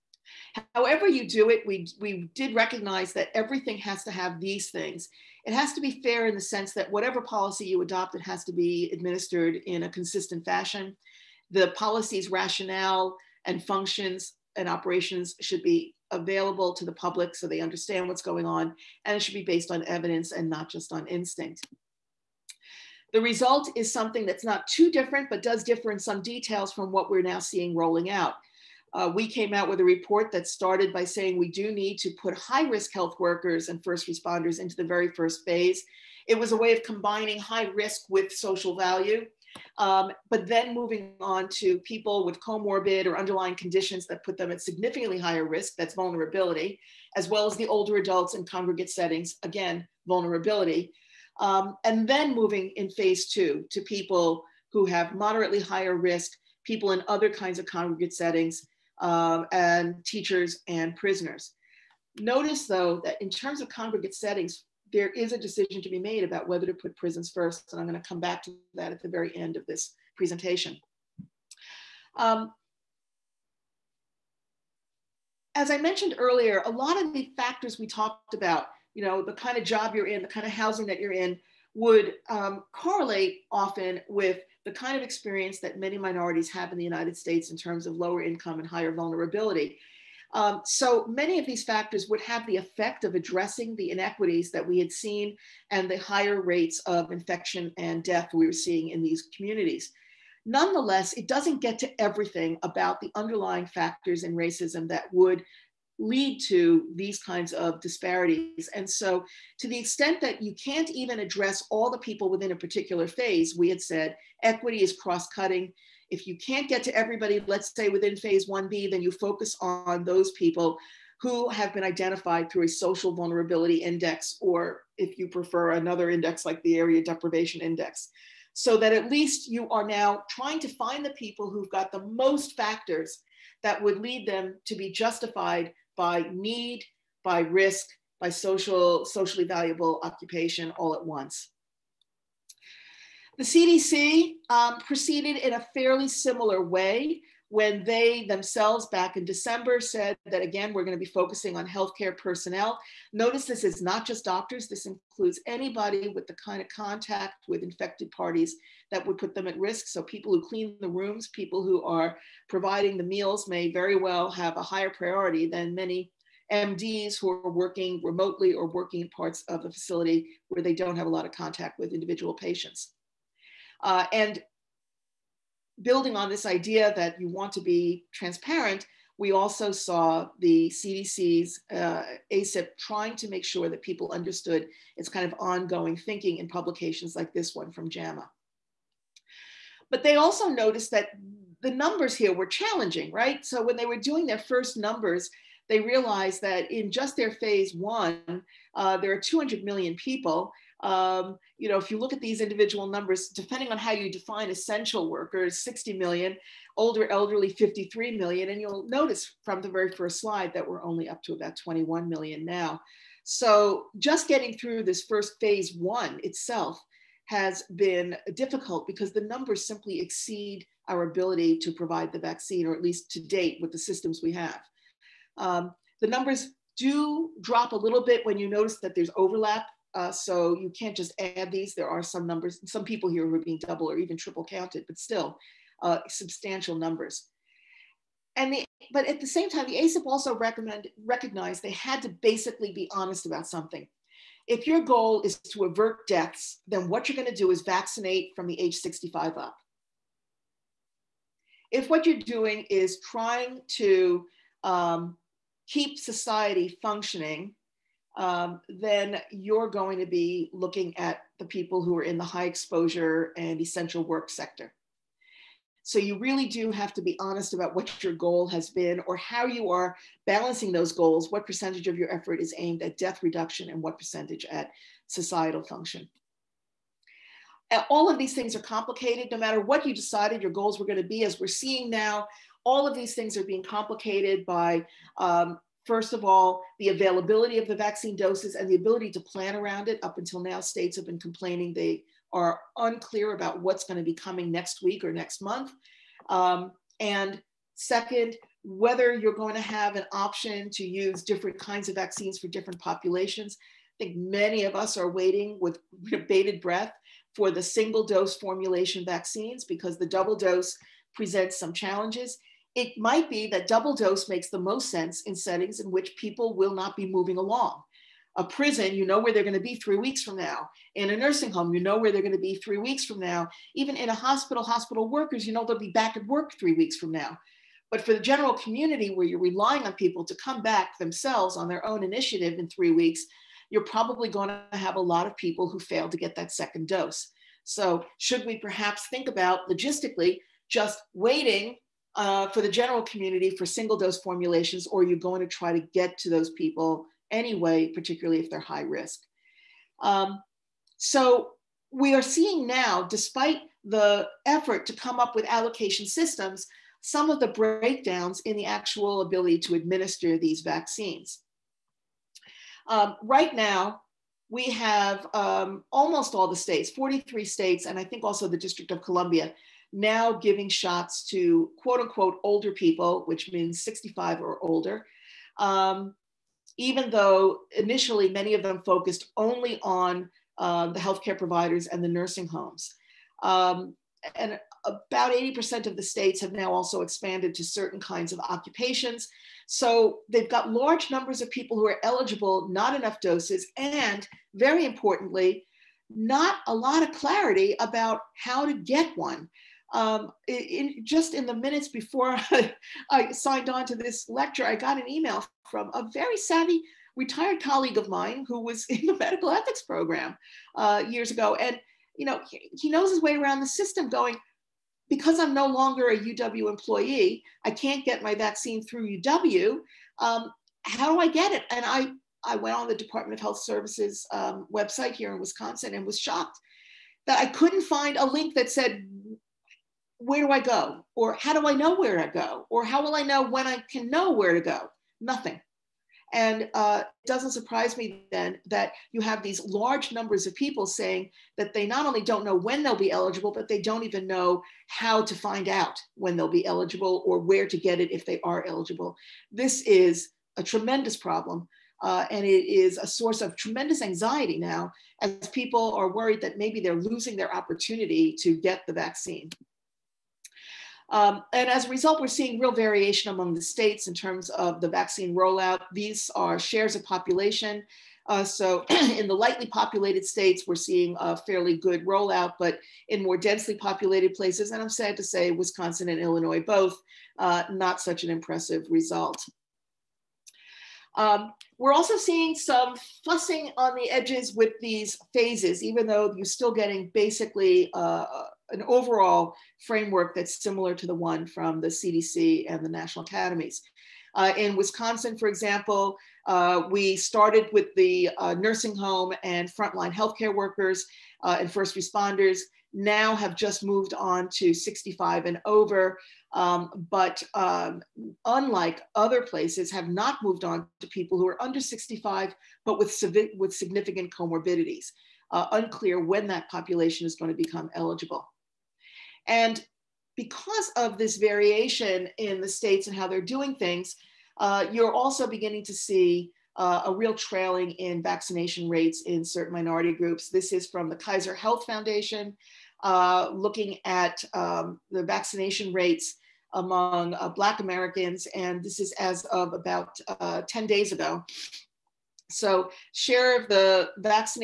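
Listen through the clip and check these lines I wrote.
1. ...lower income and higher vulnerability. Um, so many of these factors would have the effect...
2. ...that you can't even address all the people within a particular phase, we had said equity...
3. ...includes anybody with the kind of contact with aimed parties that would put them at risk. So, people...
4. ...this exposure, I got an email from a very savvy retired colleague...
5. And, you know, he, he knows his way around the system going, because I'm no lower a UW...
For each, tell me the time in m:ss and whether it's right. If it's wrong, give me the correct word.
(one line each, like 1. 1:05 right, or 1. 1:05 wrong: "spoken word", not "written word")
1. 1:27 right
2. 1:50 right
3. 2:34 wrong: "infected", not "aimed"
4. 6:43 wrong: "lecture", not "exposure"
5. 6:51 wrong: "longer", not "lower".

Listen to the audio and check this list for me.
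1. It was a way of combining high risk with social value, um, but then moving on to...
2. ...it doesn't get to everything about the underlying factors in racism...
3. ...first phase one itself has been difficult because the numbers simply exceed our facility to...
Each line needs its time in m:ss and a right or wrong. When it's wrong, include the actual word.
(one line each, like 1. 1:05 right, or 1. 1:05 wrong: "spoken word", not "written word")
1. 0:36 right
2. 1:41 right
3. 3:35 wrong: "ability", not "facility".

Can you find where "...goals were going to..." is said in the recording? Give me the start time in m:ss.
4:40.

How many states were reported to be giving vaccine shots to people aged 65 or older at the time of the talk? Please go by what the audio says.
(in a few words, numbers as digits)
43.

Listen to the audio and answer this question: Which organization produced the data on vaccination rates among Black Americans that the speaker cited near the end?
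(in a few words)
Kaiser Health Foundation.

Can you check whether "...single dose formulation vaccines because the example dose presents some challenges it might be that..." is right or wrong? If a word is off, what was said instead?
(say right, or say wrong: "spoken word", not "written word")
wrong: "double", not "example".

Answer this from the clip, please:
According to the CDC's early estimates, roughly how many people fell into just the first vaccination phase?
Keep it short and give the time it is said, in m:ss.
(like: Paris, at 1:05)
200 million, at 3:19.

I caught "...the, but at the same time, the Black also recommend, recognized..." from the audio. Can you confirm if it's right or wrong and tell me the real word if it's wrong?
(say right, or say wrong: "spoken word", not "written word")
wrong: "ACIP", not "Black".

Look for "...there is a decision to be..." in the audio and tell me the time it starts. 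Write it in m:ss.
1:04.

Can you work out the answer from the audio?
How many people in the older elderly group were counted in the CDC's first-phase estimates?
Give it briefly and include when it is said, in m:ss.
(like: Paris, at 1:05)
53 million, at 3:27.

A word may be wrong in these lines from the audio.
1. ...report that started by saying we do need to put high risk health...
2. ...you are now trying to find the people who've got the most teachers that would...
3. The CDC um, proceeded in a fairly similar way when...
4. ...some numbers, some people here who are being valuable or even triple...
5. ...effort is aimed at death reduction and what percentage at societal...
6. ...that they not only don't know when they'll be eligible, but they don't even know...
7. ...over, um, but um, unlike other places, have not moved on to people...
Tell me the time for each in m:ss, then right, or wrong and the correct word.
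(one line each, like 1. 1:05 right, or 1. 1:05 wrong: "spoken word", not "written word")
1. 0:29 right
2. 2:09 wrong: "factors", not "teachers"
3. 2:23 right
4. 3:52 wrong: "double", not "valuable"
5. 4:32 right
6. 7:21 right
7. 8:25 right.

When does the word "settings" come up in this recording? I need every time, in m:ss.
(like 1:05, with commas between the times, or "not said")
0:48, 0:58, 1:04, 5:15.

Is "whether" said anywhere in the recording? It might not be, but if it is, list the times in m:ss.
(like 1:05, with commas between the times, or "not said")
1:06, 4:58.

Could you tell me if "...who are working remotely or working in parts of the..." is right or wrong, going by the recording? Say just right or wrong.
right.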